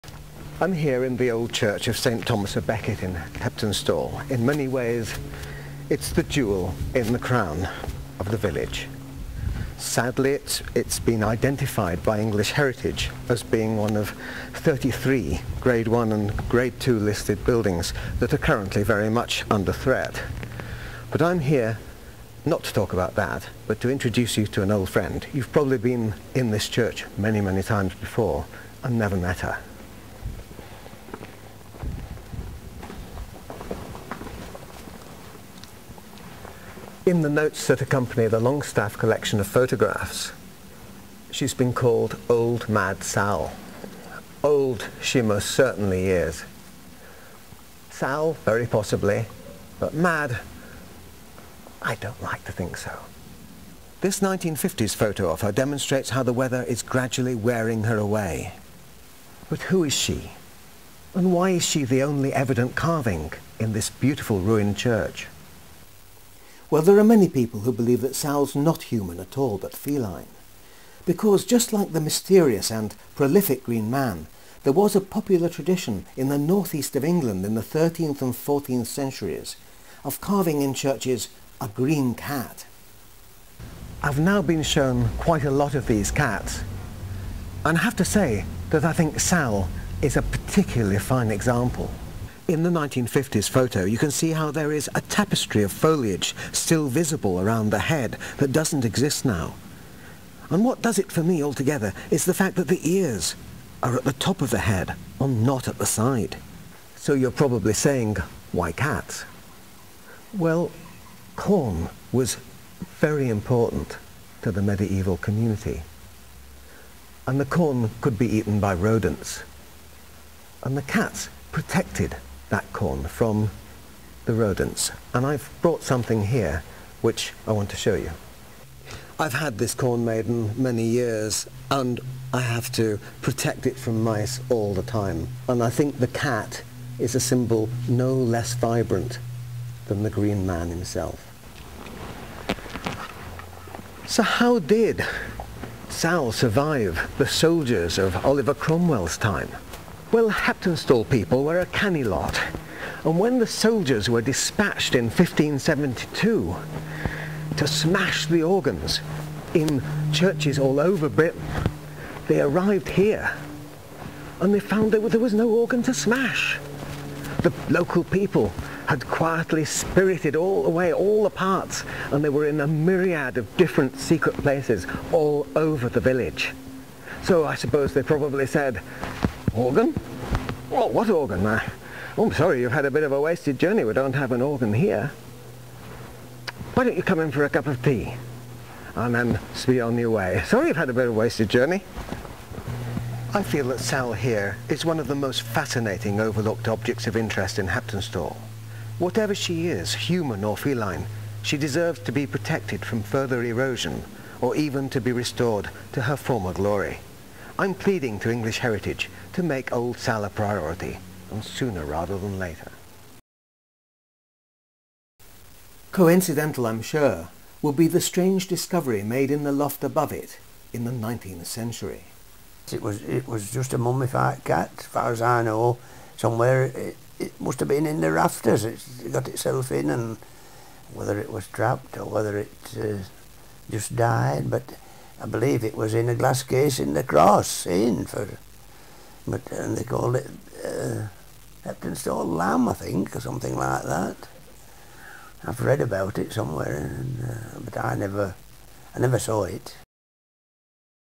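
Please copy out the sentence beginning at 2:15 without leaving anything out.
And I think the cat is a symbol no less vibrant than the green man himself.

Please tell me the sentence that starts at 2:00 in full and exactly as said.
And the cats protected that corn from the rodents.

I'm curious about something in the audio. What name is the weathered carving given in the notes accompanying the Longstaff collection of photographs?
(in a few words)
Old Mad Sal.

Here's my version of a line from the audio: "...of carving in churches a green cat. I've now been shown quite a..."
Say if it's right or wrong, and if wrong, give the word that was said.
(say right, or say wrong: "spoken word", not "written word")
right.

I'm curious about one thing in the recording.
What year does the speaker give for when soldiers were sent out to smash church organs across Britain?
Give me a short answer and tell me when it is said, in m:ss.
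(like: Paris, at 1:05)
1572, at 2:35.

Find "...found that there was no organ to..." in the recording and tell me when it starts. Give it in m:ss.
2:44.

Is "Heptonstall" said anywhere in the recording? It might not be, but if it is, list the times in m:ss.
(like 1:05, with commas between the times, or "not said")
0:03, 2:30, 3:17, 4:01.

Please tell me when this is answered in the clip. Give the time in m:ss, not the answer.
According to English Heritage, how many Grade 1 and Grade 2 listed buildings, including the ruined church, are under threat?
0:14.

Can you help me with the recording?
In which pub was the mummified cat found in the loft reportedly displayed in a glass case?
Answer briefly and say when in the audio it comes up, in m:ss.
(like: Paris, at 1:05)
The Cross Inn, at 3:57.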